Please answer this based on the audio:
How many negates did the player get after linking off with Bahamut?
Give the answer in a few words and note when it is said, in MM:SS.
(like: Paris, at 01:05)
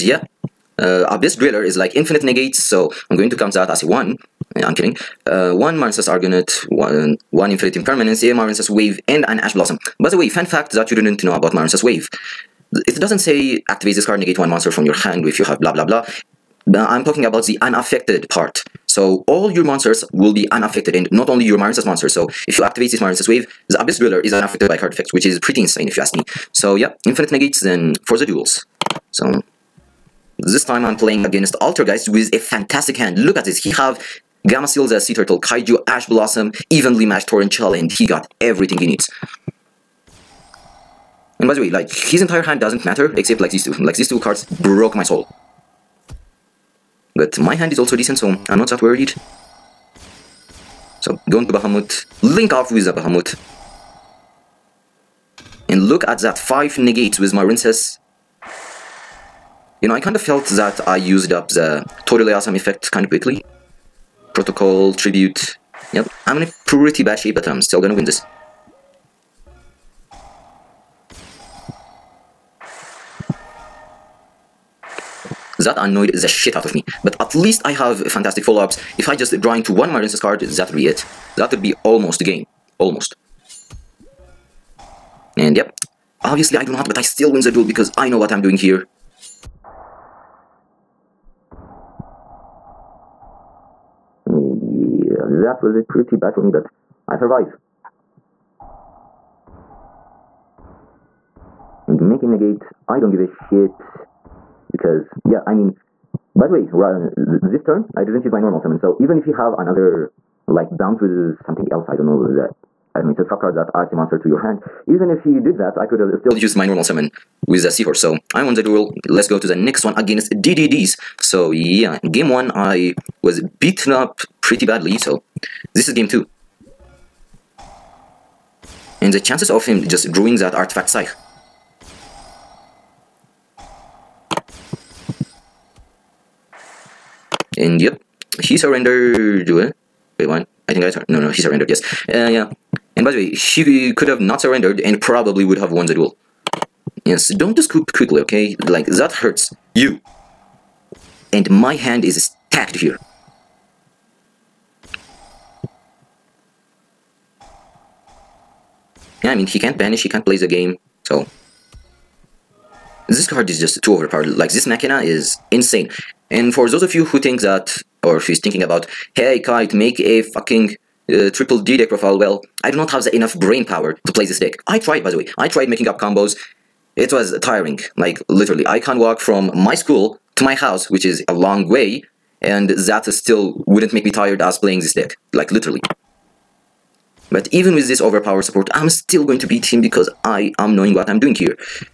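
5, at 00:56.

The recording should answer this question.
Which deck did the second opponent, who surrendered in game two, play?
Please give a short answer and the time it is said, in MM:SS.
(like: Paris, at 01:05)
DDDs, at 02:00.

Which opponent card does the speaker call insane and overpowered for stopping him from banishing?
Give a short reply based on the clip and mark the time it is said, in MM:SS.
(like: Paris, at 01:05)
Machina, at 02:44.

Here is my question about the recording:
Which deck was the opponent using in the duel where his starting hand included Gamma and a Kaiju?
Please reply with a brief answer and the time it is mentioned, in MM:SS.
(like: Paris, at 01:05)
Altergeist, at 00:31.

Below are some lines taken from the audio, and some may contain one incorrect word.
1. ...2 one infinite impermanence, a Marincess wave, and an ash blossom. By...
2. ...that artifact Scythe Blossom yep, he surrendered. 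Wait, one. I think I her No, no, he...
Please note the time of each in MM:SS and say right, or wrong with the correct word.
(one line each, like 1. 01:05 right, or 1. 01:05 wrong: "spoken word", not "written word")
1. 00:06 wrong: "1", not "2"
2. 02:10 wrong: "And", not "Blossom".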